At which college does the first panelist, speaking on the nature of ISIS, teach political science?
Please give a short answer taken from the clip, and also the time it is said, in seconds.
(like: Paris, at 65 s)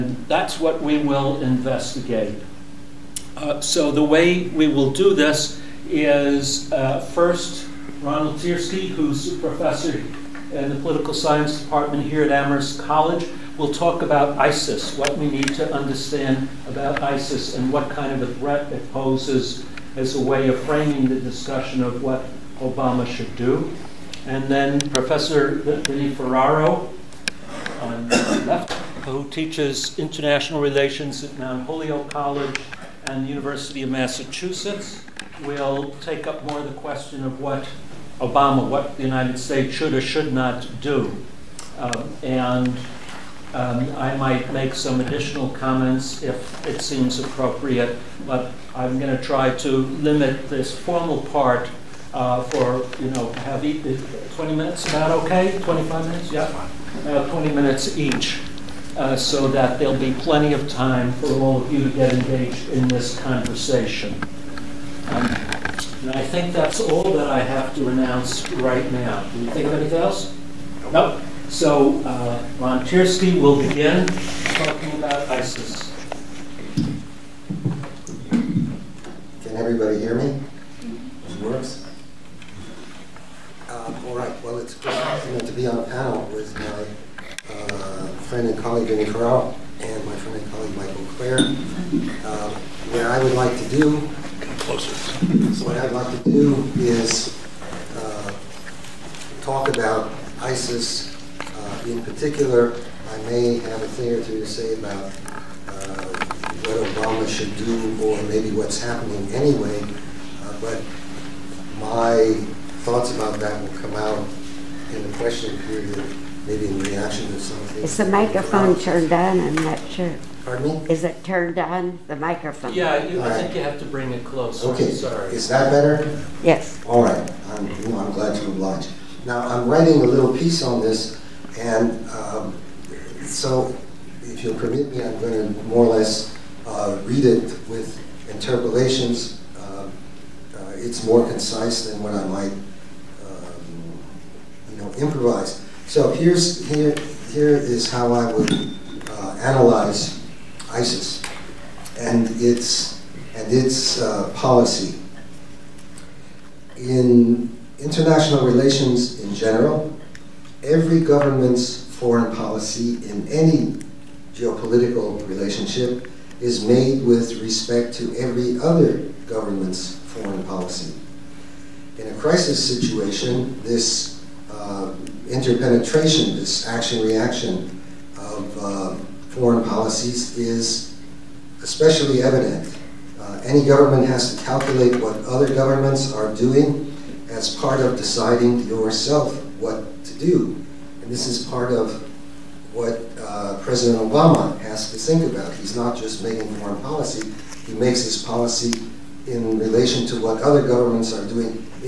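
Amherst College, at 12 s.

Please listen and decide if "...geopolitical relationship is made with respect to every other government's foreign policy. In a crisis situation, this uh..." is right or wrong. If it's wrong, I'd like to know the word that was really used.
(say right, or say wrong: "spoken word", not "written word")
right.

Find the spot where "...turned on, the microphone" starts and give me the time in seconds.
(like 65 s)
121 s.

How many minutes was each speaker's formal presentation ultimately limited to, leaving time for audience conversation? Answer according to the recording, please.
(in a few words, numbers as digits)
20.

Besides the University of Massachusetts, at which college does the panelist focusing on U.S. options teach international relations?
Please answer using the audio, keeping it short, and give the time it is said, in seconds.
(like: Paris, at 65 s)
Mount Holyoke College, at 31 s.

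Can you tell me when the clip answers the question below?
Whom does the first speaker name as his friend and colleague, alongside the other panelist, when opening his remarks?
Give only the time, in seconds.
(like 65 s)
90 s.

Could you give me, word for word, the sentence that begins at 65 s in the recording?
Um, and I think that's all that I have to announce right now.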